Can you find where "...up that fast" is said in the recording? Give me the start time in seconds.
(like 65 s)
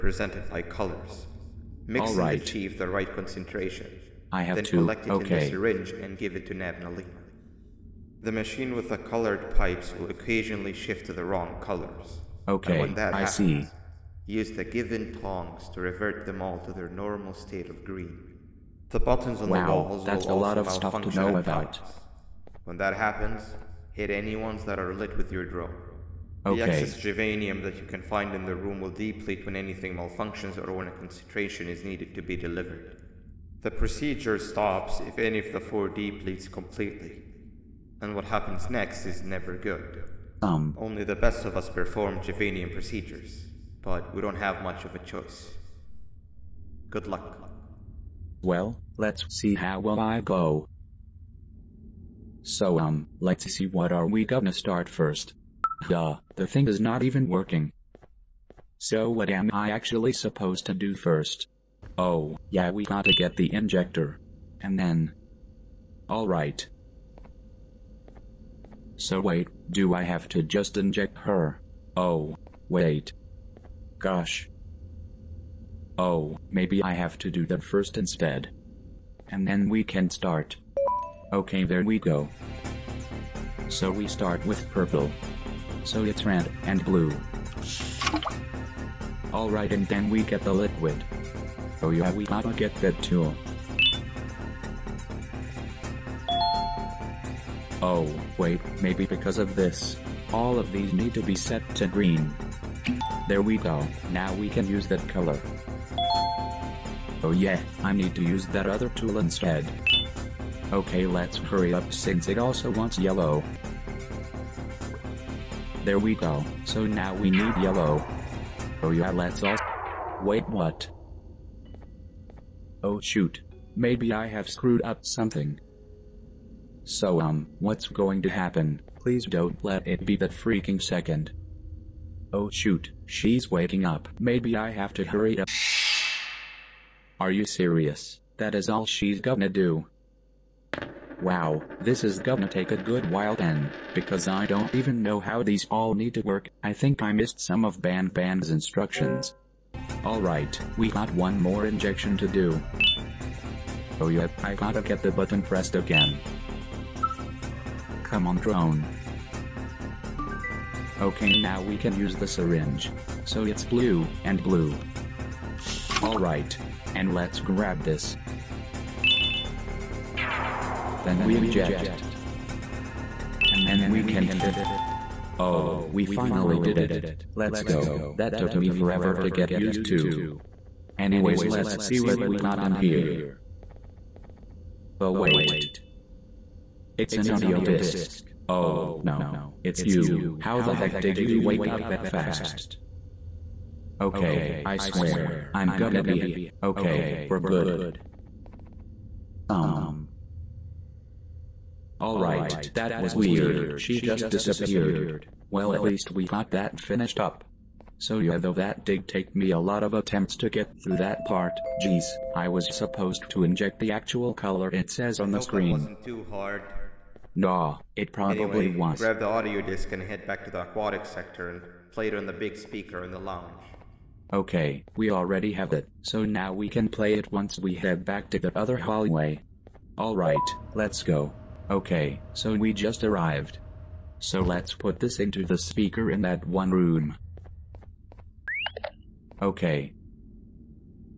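191 s.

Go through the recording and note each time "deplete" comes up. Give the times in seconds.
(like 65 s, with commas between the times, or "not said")
28 s, 35 s.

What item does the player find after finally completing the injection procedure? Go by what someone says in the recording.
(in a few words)
An audio disc.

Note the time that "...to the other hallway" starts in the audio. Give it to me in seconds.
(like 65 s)
228 s.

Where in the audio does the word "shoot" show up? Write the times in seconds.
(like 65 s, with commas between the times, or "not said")
122 s, 132 s.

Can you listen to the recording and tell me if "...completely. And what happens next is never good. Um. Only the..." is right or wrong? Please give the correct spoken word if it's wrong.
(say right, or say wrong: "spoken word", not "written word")
right.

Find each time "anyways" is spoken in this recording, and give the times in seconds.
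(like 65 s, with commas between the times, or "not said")
180 s, 218 s.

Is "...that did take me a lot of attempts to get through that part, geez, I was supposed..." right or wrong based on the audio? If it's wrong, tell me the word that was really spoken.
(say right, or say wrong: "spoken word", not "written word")
right.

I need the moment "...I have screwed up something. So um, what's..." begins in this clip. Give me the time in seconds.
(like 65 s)
124 s.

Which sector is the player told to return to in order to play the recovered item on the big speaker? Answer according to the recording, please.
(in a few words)
Aquatic sector.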